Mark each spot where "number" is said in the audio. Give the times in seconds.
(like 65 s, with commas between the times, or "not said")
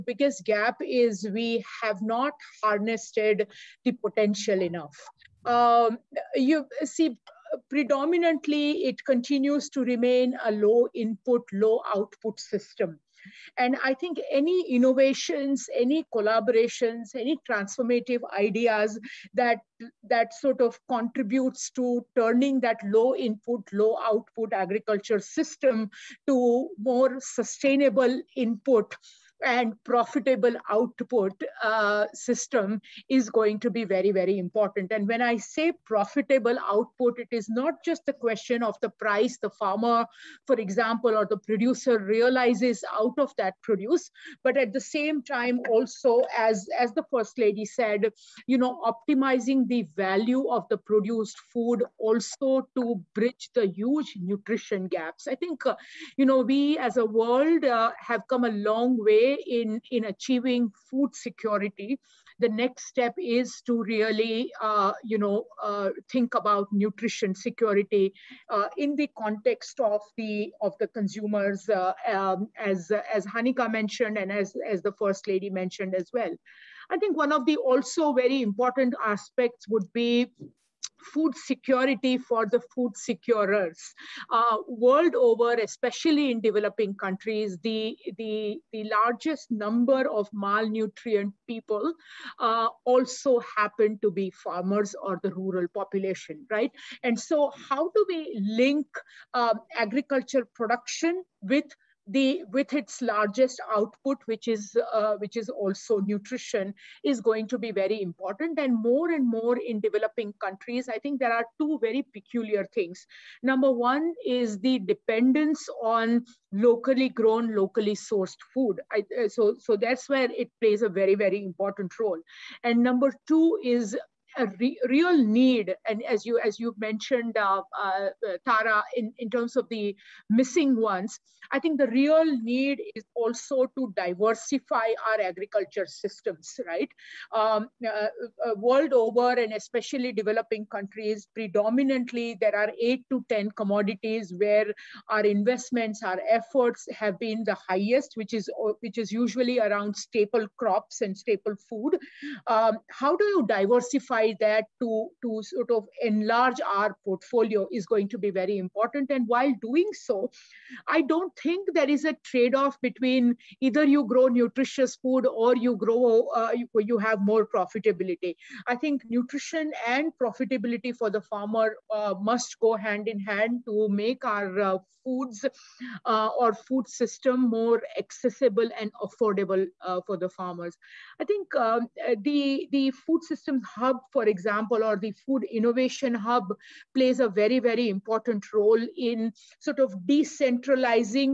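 89 s, 113 s, 122 s.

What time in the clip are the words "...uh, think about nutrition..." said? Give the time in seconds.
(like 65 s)
65 s.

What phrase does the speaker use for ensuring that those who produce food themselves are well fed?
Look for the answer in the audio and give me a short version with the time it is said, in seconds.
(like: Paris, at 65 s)
food security for the food securers, at 81 s.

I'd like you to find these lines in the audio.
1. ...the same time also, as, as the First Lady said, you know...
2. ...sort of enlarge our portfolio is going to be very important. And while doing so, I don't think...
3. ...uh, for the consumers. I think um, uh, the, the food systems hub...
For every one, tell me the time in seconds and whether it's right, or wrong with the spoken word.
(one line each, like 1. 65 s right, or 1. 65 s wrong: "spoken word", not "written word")
1. 44 s right
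2. 155 s right
3. 179 s wrong: "farmers", not "consumers".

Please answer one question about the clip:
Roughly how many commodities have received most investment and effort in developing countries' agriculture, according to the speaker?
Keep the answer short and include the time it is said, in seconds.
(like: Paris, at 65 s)
8 to 10, at 142 s.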